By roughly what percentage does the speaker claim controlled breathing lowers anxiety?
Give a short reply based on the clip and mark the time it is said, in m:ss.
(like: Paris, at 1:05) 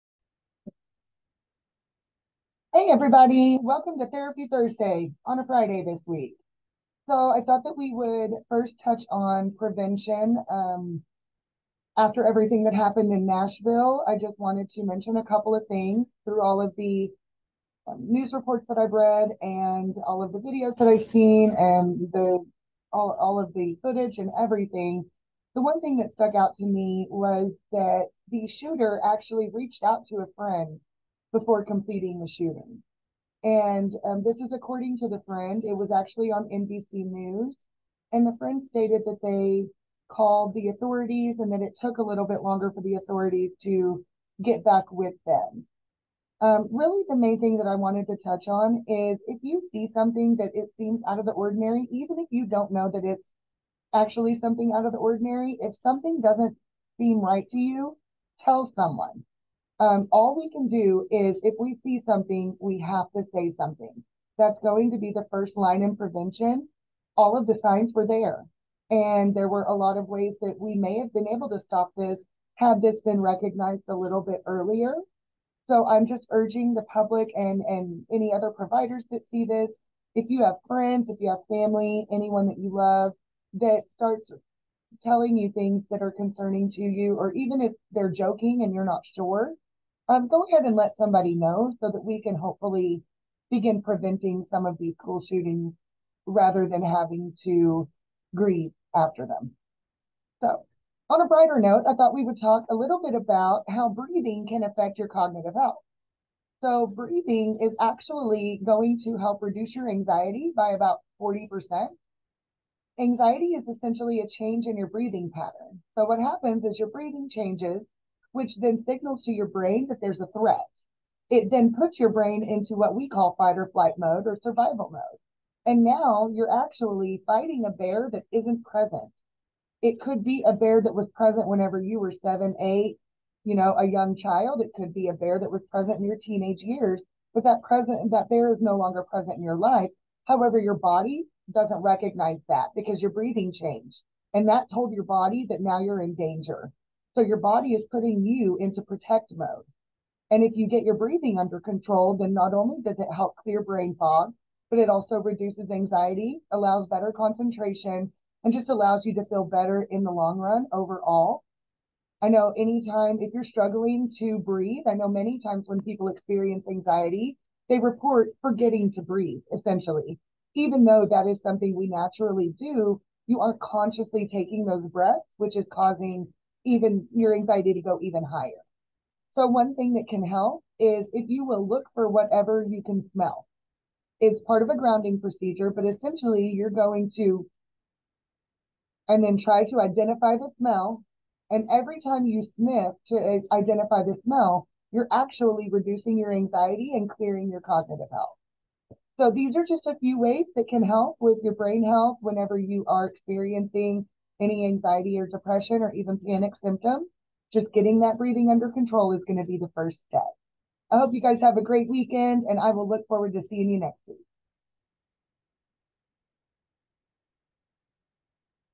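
40%, at 1:51.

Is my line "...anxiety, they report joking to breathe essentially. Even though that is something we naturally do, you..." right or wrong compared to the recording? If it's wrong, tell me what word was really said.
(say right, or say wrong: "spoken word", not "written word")
wrong: "forgetting", not "joking".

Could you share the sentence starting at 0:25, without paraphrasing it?
The one thing that stuck out to me was that the shooter actually reached out to a friend before completing the shooting.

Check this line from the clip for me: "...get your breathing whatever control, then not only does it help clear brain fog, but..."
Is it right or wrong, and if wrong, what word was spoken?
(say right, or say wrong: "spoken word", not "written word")
wrong: "under", not "whatever".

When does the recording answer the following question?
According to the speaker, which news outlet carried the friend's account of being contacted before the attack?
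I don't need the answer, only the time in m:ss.
0:36.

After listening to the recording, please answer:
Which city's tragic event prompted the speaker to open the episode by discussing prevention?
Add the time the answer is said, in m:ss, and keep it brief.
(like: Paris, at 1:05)
Nashville, at 0:13.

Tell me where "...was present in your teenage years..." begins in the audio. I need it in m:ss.
2:15.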